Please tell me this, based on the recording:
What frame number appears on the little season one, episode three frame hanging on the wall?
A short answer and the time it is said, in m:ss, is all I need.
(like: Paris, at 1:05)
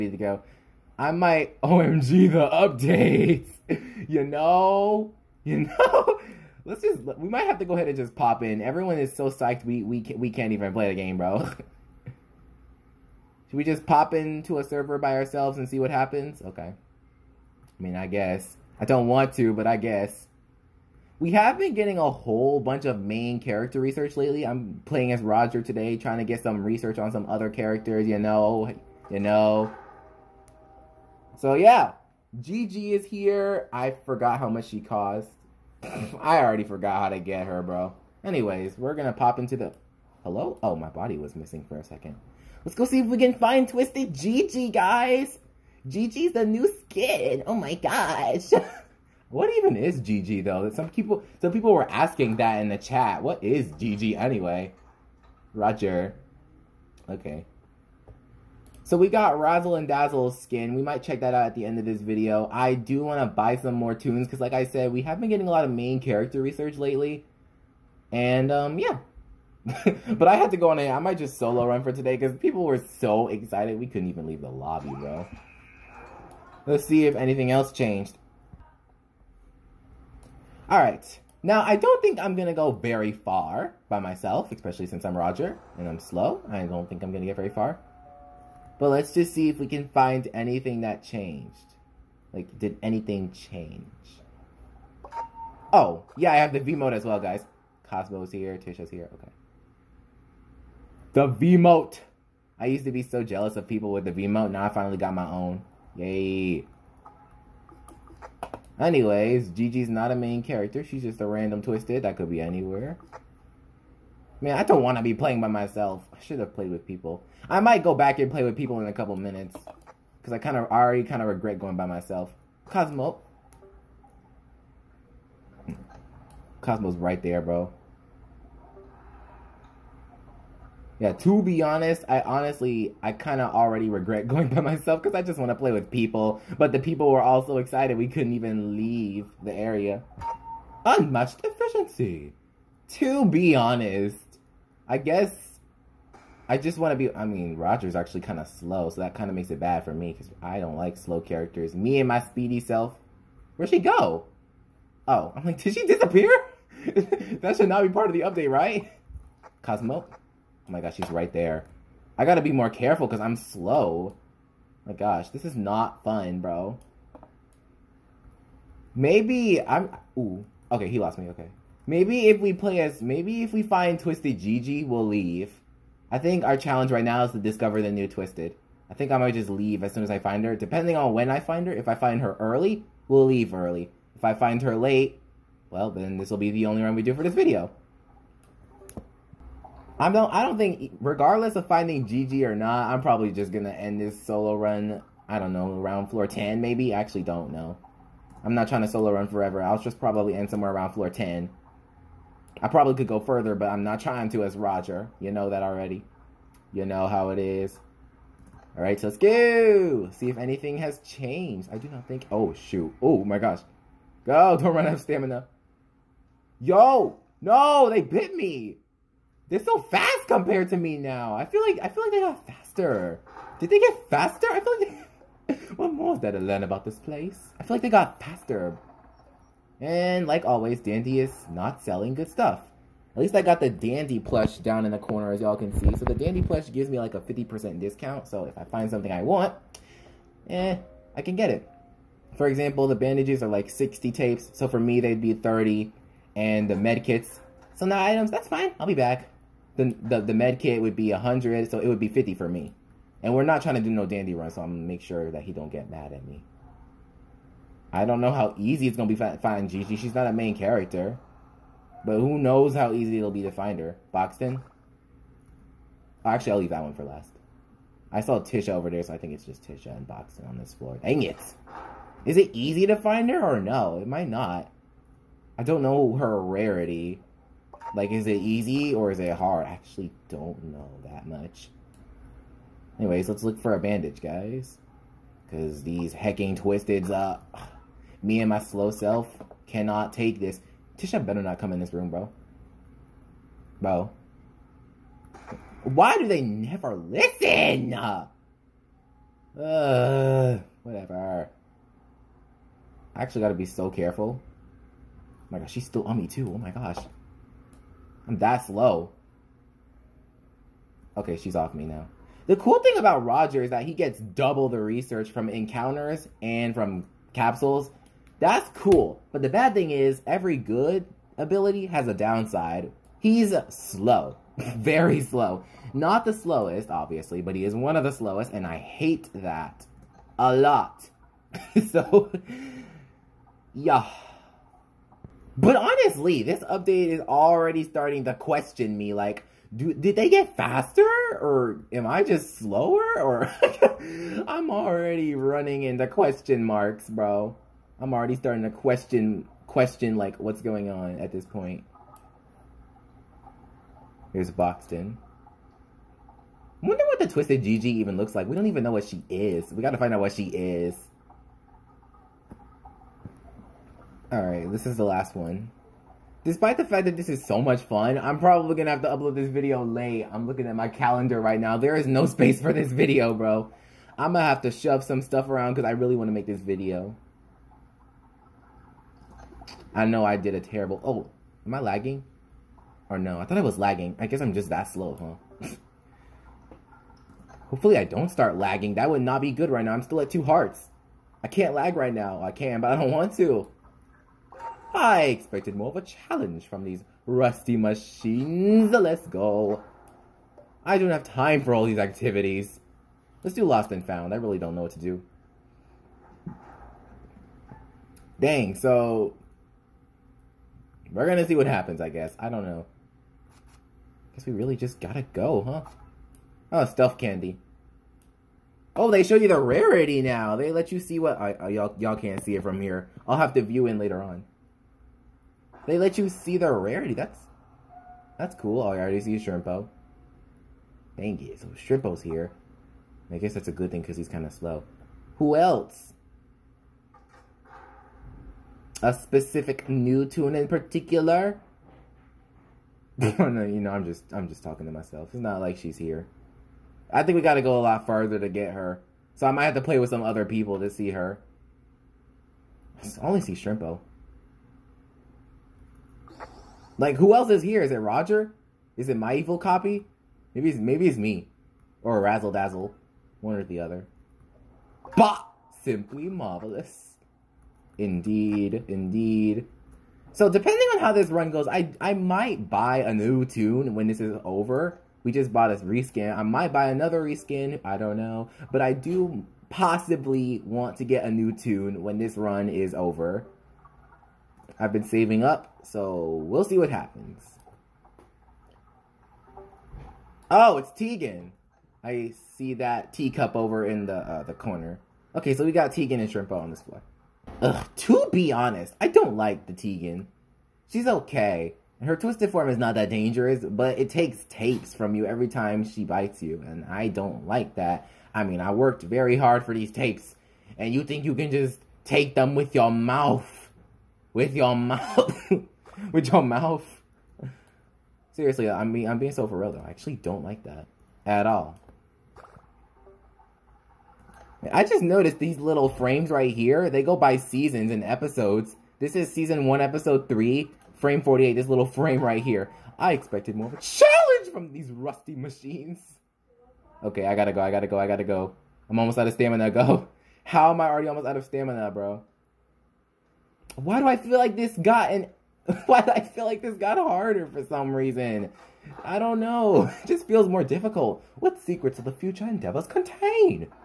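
48, at 8:50.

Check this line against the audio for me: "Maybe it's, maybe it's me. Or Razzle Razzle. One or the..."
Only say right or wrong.
wrong.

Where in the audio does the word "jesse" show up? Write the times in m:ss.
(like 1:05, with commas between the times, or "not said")
not said.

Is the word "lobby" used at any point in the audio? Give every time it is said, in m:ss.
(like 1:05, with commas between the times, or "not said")
1:14.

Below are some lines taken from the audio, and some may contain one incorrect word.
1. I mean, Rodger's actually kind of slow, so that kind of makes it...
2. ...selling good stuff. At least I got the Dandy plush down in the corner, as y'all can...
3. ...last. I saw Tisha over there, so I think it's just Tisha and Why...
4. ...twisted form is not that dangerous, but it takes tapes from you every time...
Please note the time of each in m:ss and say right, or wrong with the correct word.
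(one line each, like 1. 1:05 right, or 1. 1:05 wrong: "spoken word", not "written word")
1. 2:27 right
2. 3:51 right
3. 4:27 wrong: "Boxten", not "Why"
4. 8:22 right.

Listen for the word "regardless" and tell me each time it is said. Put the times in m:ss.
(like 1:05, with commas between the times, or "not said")
3:11.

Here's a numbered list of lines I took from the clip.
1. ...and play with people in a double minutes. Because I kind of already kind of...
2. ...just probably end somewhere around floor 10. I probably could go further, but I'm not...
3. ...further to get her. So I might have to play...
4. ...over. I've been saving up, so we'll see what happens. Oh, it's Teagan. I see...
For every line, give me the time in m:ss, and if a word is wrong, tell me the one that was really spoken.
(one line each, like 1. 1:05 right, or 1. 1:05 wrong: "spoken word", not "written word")
1. 1:58 wrong: "couple", not "double"
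2. 3:19 right
3. 7:28 right
4. 8:02 right.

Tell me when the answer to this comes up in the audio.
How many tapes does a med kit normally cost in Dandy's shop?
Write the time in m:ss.
4:11.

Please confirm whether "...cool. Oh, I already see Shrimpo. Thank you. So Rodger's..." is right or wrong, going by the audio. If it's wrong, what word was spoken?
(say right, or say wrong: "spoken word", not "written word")
wrong: "Shrimpo", not "Rodger".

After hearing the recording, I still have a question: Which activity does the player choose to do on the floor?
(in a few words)
Lost and Found.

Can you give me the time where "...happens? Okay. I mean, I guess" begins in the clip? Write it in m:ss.
0:15.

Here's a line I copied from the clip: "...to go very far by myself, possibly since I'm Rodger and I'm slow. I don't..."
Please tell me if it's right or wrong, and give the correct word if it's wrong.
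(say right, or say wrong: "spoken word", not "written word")
wrong: "especially", not "possibly".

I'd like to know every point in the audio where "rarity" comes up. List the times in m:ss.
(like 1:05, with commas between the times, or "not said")
4:36, 6:59, 7:06.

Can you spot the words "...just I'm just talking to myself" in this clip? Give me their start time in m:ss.
7:24.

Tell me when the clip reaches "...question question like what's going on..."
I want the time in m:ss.
5:48.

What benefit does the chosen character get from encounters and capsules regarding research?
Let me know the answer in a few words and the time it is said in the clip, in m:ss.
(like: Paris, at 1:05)
Double the research, at 5:14.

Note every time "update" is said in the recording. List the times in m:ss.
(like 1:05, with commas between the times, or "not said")
0:02, 2:38, 5:36.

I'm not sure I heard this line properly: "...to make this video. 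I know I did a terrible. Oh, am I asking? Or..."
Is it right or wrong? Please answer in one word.
wrong.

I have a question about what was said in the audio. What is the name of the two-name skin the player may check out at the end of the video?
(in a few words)
Razzle and Dazzle.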